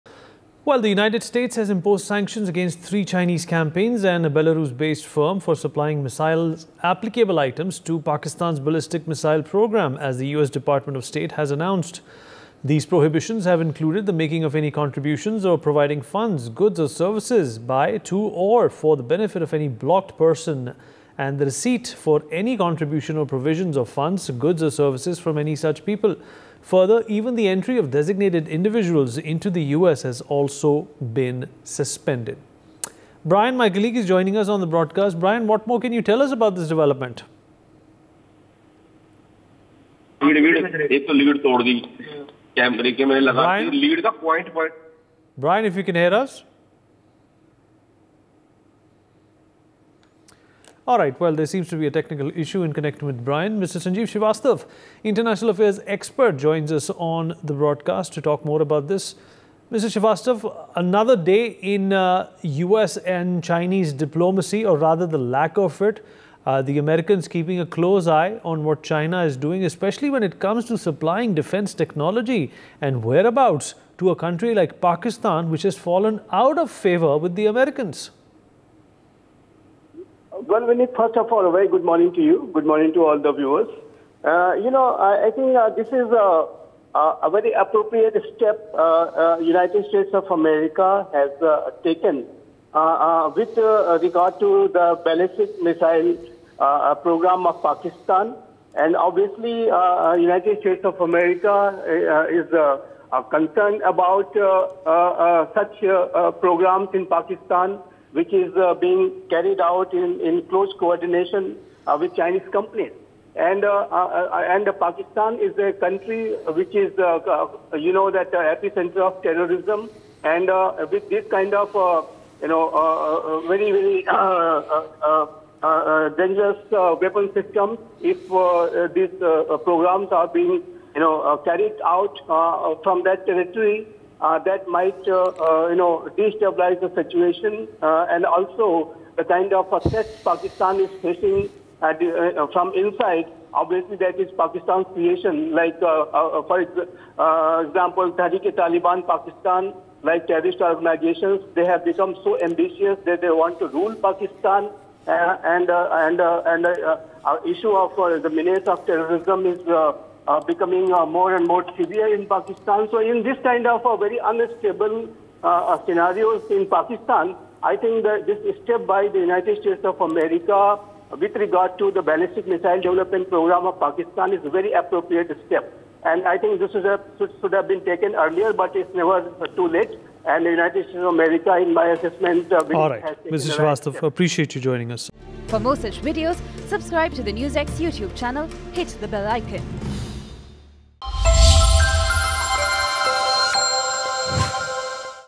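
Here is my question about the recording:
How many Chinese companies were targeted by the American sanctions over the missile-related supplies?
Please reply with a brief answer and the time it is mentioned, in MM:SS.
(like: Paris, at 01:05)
3, at 00:02.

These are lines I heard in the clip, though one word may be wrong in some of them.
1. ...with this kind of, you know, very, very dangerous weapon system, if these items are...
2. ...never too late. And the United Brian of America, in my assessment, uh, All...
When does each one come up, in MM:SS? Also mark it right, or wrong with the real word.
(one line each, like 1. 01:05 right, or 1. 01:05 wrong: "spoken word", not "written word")
1. 02:00 wrong: "programs", not "items"
2. 02:58 wrong: "States", not "Brian".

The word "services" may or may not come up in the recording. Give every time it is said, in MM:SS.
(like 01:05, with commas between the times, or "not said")
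00:16, 00:24.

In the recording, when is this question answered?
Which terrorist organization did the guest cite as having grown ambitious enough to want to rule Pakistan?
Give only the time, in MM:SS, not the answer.
02:28.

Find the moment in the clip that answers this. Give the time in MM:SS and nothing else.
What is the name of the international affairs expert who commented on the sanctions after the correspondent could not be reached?
00:53.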